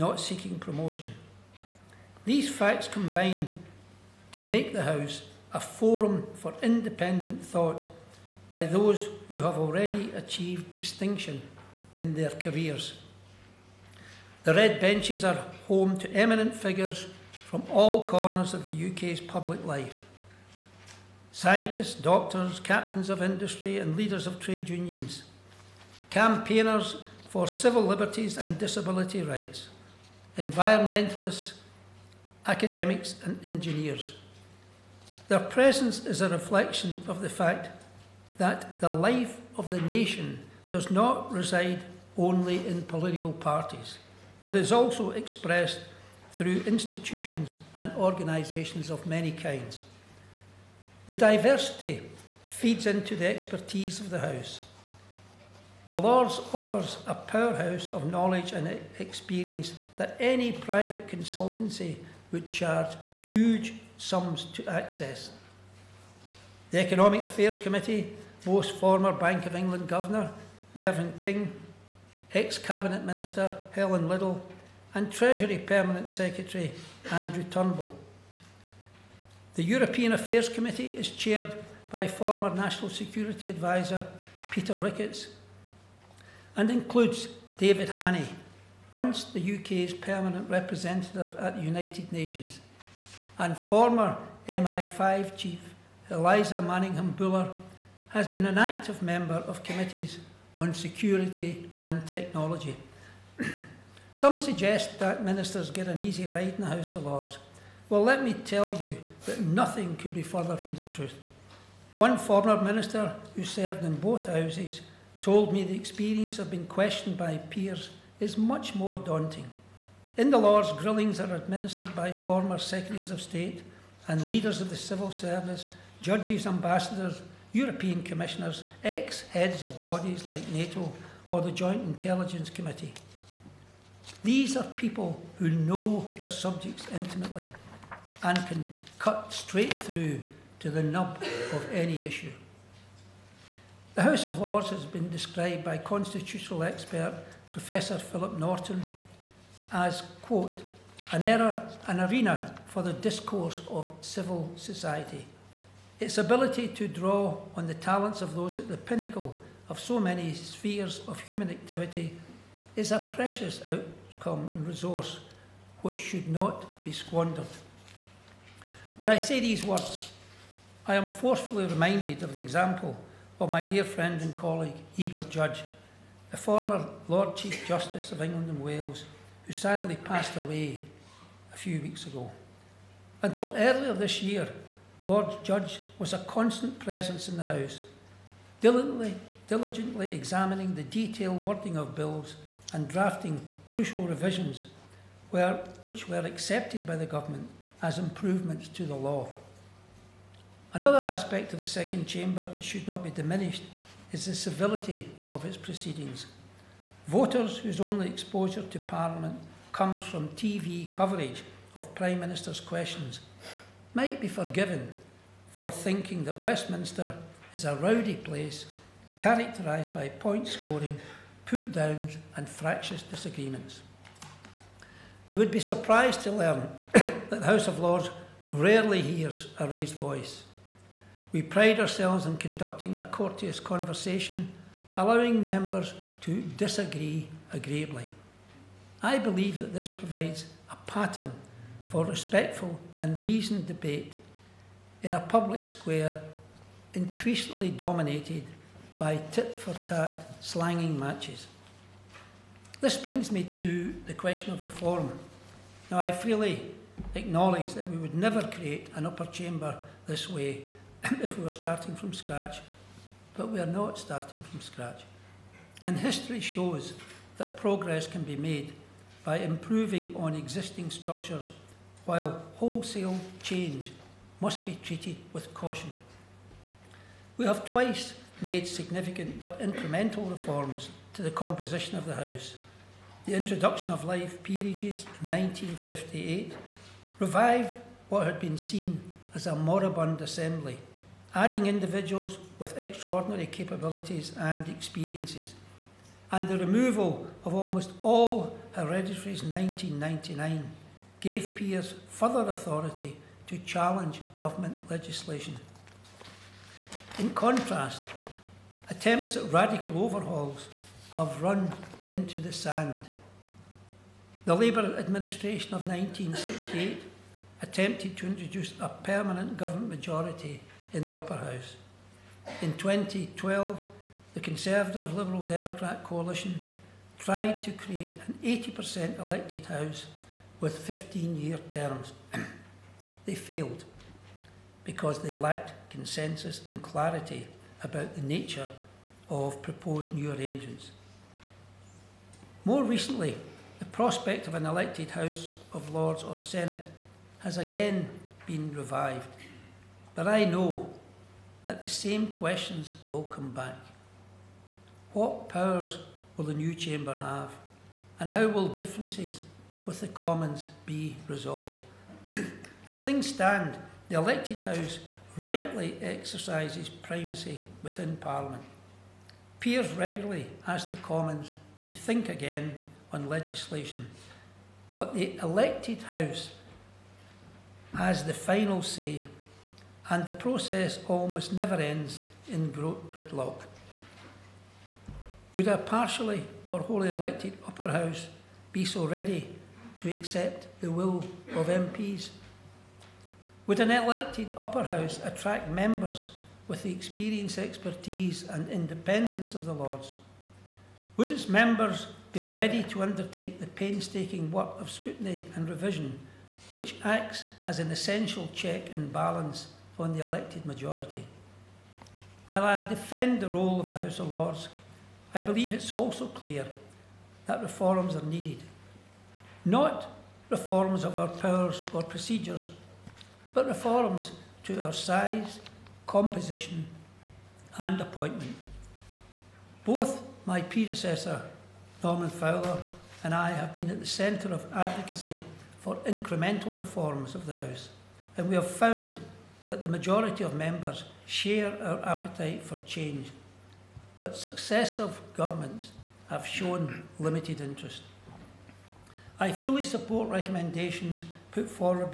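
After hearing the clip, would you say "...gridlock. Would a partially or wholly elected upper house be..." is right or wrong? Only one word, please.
right.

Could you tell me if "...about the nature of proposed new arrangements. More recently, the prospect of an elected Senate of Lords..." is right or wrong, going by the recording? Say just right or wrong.
wrong.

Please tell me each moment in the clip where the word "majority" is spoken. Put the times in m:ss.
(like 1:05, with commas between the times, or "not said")
5:19, 6:50, 7:19.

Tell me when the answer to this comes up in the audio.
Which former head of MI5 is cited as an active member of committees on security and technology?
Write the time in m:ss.
1:36.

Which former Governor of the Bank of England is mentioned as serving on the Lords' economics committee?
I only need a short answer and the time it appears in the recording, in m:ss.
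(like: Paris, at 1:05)
Mervyn King, at 1:10.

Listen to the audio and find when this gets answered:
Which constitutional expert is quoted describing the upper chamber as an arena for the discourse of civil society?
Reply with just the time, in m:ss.
2:27.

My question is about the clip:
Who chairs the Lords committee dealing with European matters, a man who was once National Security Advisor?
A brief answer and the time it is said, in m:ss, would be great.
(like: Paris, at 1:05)
Peter Ricketts, at 1:24.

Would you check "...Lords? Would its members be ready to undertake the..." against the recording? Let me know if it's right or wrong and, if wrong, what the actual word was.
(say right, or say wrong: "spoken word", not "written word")
right.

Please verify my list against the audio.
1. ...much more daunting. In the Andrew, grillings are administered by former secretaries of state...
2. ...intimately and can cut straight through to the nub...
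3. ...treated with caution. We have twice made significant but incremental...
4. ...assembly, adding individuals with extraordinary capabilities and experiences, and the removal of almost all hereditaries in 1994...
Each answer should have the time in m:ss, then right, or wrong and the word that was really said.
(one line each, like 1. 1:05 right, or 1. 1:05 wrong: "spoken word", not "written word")
1. 1:58 wrong: "Lords", not "Andrew"
2. 2:16 right
3. 4:34 right
4. 4:50 wrong: "1999", not "1994".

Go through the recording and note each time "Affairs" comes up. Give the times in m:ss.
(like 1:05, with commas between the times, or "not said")
1:07, 1:20.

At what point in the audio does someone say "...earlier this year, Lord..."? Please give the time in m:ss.
3:03.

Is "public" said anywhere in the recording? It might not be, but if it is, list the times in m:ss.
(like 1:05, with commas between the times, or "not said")
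0:19, 4:05.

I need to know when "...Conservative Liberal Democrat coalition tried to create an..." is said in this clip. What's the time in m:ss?
5:24.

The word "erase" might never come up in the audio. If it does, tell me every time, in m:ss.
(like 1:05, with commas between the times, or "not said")
not said.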